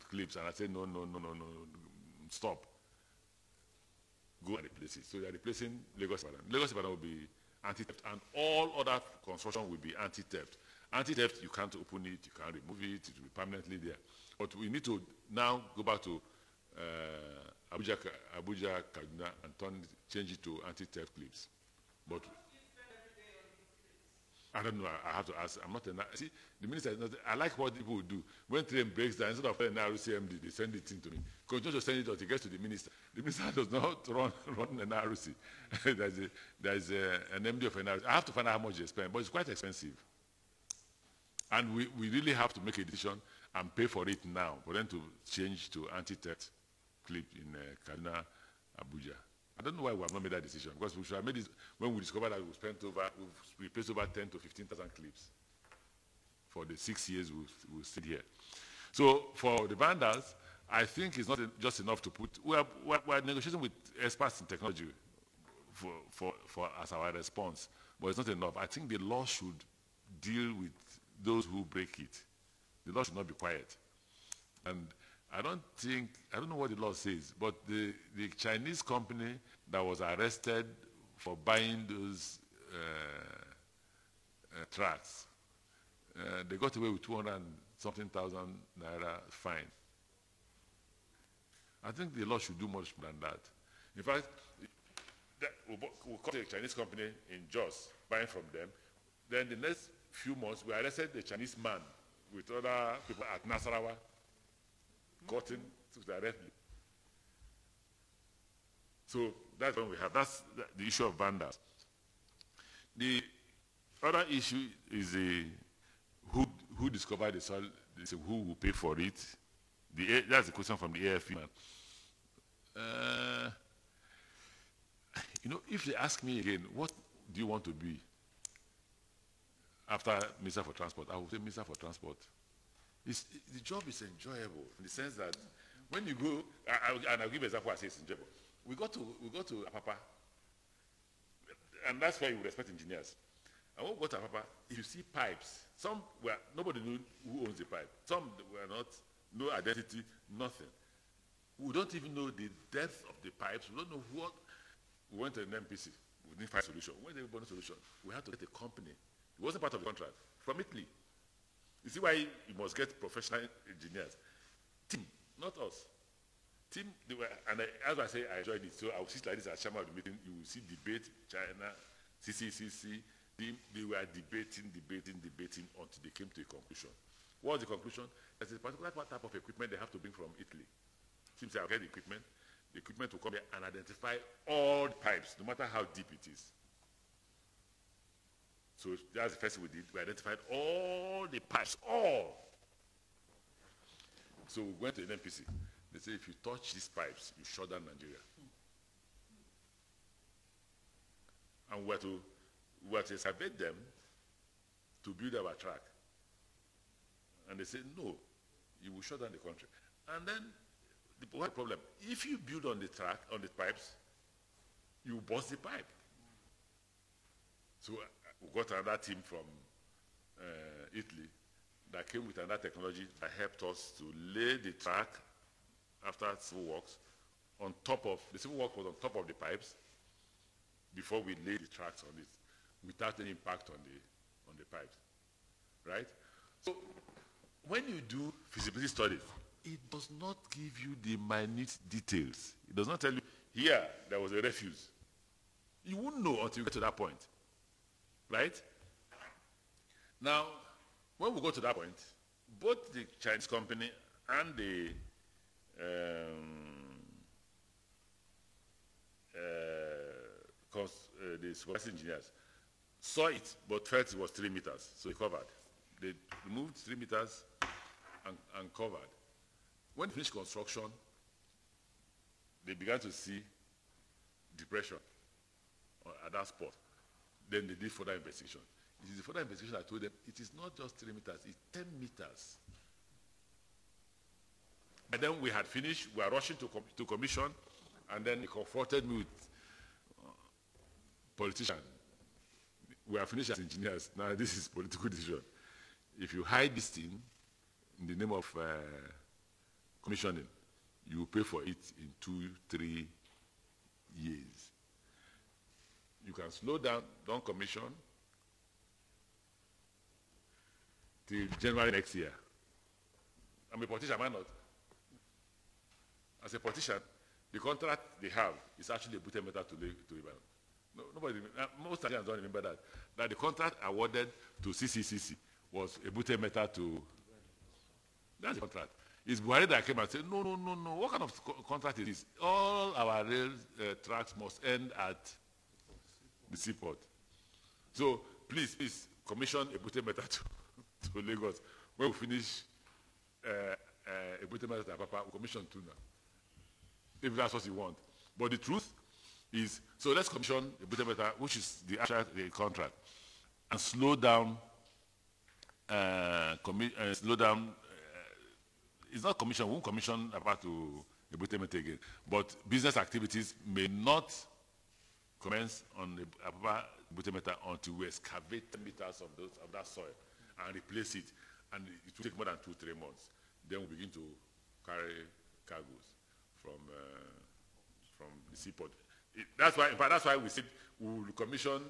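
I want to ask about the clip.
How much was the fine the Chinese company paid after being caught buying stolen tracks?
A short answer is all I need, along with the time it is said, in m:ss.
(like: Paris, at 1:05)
200 something thousand naira, at 1:27.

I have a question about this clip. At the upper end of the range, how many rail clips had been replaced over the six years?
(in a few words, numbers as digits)
15,000.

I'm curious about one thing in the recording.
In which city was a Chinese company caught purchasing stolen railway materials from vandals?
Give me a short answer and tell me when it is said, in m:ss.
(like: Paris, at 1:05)
Jos, at 1:37.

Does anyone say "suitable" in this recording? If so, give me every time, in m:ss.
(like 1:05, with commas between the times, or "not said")
not said.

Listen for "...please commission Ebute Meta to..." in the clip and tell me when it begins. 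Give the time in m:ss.
5:38.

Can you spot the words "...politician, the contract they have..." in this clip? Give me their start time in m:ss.
5:16.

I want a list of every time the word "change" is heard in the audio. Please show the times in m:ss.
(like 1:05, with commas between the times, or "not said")
0:20, 0:45.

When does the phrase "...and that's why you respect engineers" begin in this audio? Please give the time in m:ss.
2:21.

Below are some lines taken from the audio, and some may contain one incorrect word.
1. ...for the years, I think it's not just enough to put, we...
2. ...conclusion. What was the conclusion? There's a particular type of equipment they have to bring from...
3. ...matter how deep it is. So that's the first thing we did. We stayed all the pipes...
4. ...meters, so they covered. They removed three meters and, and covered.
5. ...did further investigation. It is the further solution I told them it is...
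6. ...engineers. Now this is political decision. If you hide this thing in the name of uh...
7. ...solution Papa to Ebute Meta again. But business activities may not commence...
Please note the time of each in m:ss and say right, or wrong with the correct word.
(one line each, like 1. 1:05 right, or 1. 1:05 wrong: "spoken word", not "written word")
1. 0:59 wrong: "vendors", not "years"
2. 2:56 right
3. 3:05 wrong: "identified", not "stayed"
4. 4:24 right
5. 4:37 wrong: "investigation", not "solution"
6. 4:53 right
7. 5:59 wrong: "commission", not "solution".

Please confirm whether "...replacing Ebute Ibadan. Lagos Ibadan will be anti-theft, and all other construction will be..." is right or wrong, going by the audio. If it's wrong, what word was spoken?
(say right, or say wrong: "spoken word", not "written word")
wrong: "Lagos", not "Ebute".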